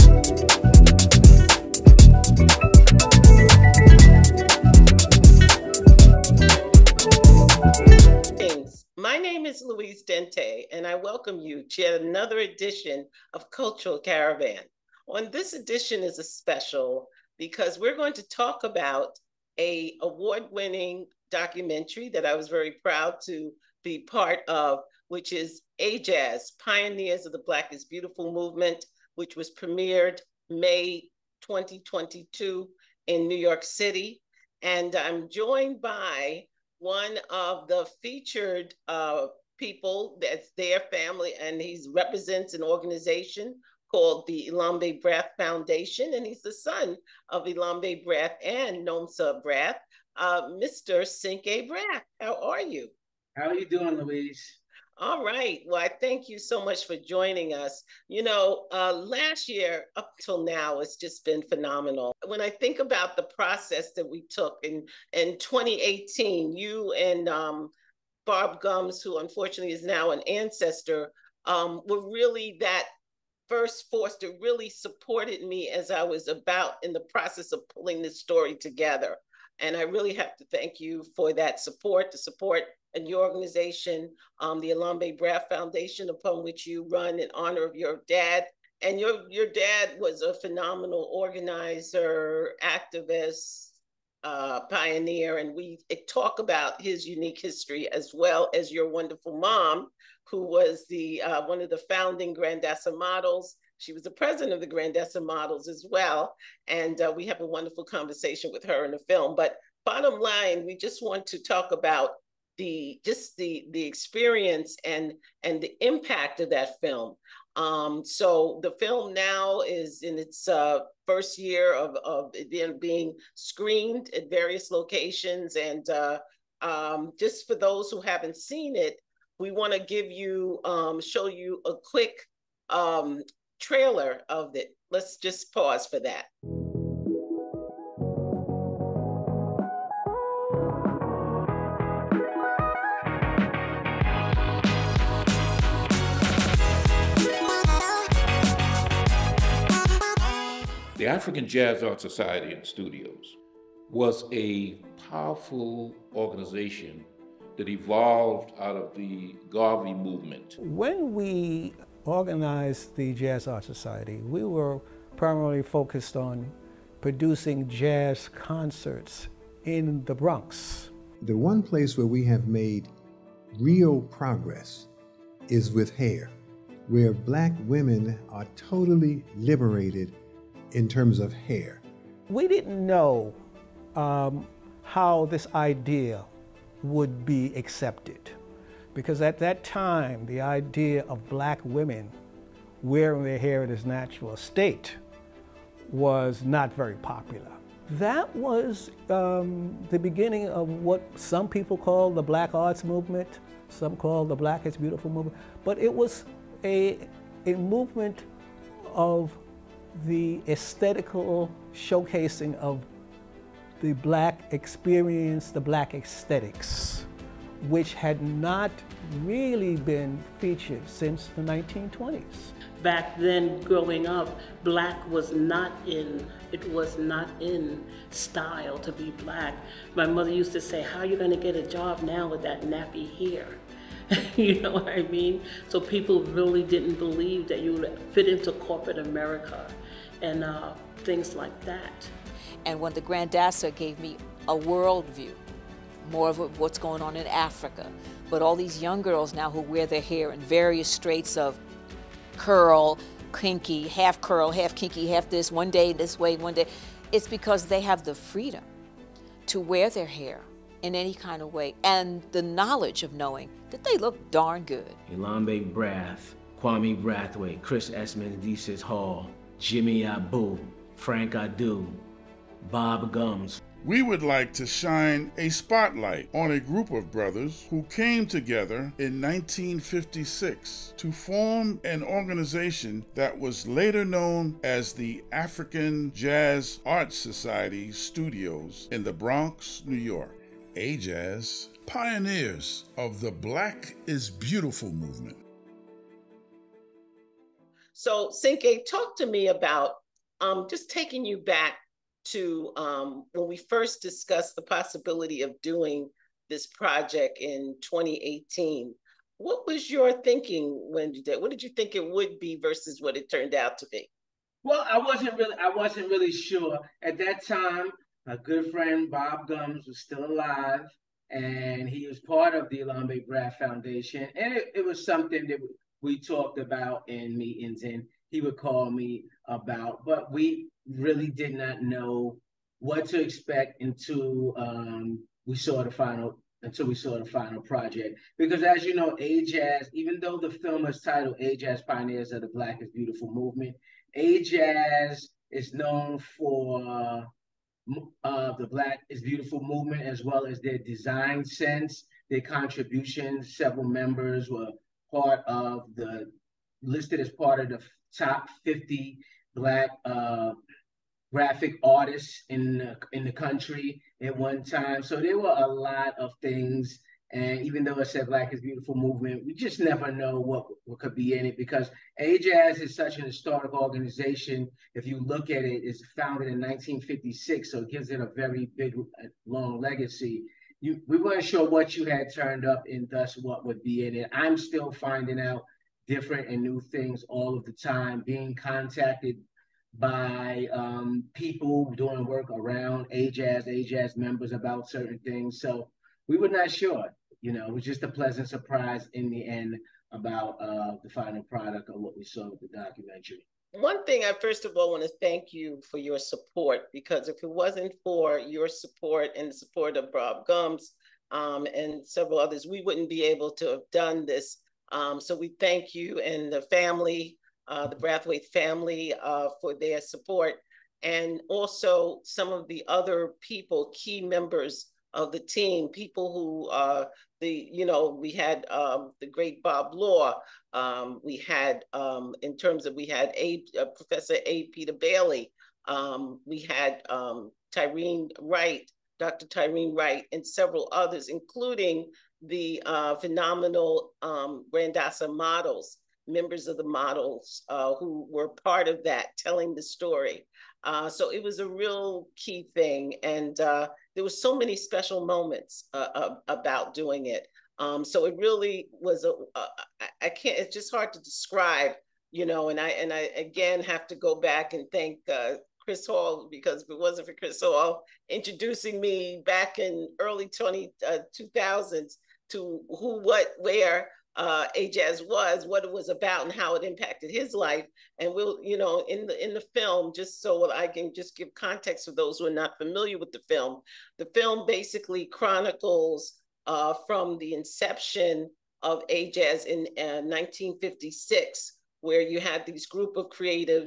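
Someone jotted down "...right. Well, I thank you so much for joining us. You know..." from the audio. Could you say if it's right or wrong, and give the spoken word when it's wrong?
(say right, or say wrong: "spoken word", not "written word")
right.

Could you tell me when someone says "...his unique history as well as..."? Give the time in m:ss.
1:36.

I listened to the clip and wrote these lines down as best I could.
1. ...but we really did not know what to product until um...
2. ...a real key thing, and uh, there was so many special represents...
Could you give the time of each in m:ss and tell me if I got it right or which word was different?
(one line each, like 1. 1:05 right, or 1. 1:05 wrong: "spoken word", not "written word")
1. 5:30 wrong: "expect", not "product"
2. 7:31 wrong: "moments", not "represents".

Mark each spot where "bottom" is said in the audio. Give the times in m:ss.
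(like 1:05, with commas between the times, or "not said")
1:49.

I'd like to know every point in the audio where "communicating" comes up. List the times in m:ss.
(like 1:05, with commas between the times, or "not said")
not said.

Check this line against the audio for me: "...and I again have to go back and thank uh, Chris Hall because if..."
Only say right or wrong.
right.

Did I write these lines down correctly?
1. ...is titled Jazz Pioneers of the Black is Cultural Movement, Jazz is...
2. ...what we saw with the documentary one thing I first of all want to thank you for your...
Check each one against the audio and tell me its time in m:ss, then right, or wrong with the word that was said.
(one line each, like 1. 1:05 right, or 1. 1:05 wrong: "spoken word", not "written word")
1. 5:40 wrong: "Beautiful", not "Cultural"
2. 6:41 right.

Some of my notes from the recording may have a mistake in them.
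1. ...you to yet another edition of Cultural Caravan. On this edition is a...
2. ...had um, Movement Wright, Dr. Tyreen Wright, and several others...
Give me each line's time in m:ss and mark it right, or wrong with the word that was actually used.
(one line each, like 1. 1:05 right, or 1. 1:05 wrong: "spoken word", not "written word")
1. 0:11 right
2. 7:16 wrong: "Tyreen", not "Movement".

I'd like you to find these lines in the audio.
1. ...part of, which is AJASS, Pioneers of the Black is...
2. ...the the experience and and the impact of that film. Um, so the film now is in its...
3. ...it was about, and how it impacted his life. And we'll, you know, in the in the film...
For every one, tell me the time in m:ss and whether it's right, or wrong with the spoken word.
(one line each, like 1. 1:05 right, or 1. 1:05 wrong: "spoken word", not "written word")
1. 0:24 right
2. 1:53 right
3. 7:55 right.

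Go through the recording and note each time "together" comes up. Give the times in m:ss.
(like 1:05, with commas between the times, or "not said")
1:18, 4:38.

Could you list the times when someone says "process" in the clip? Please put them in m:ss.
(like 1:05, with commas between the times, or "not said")
1:03, 1:17.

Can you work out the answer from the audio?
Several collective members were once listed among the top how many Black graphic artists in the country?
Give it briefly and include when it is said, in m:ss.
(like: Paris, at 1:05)
50, at 5:58.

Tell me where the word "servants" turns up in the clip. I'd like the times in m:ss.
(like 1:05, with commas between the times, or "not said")
not said.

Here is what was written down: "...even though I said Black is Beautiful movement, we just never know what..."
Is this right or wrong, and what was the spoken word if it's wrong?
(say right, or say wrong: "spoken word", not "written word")
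right.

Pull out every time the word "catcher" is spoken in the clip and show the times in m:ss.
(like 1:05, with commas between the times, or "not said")
not said.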